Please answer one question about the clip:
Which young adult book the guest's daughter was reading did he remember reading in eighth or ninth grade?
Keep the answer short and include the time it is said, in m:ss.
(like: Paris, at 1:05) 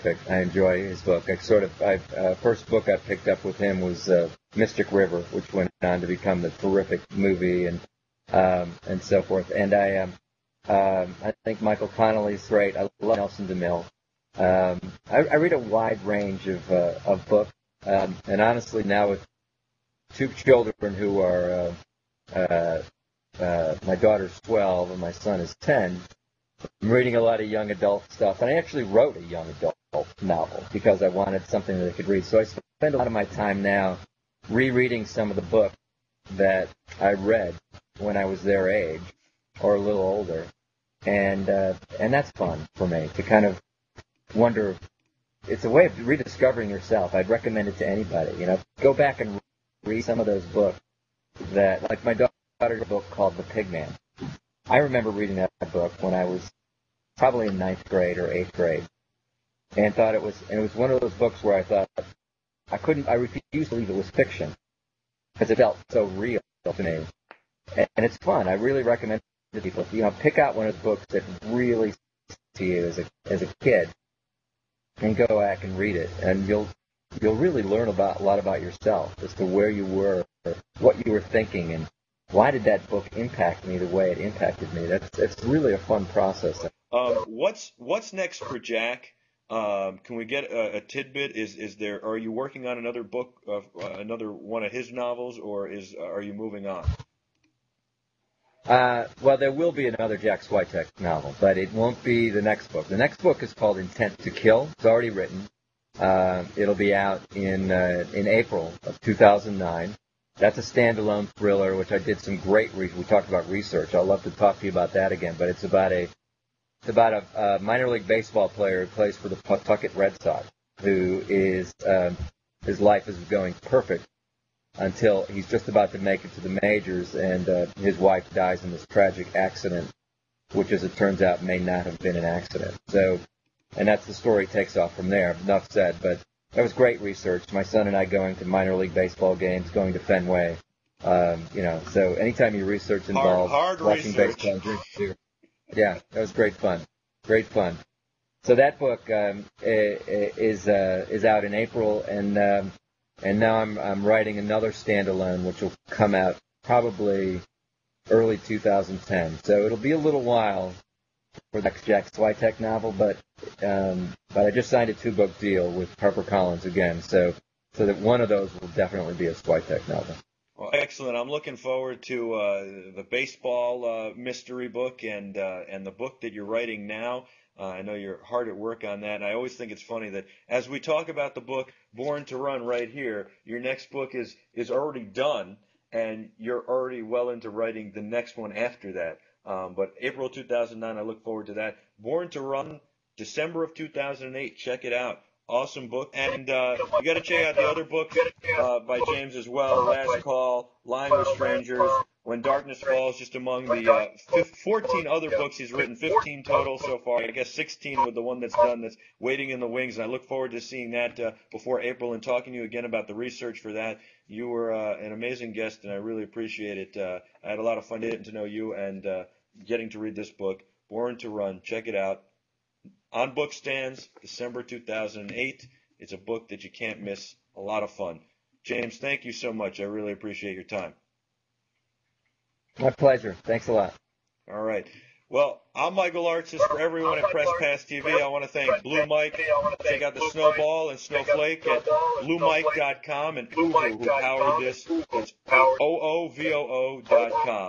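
The Pigman, at 0:53.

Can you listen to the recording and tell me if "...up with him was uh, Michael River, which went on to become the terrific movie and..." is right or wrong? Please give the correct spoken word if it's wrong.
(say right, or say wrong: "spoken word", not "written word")
wrong: "Mystic", not "Michael".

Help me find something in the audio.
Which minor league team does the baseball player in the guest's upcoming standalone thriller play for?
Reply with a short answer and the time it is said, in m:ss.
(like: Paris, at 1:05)
Pawtucket Red Sox, at 1:59.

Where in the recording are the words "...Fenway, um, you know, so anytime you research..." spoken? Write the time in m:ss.
2:19.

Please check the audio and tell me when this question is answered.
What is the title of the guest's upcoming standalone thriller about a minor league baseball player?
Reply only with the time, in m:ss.
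1:43.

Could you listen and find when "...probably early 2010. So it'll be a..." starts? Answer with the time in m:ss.
2:36.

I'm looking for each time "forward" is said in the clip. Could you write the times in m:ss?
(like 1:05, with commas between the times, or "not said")
2:51, 3:11, 3:30.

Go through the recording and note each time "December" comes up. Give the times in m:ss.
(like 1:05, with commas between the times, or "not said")
3:13, 3:44.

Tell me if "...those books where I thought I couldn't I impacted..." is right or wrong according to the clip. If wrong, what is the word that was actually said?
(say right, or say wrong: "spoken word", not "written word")
wrong: "refused", not "impacted".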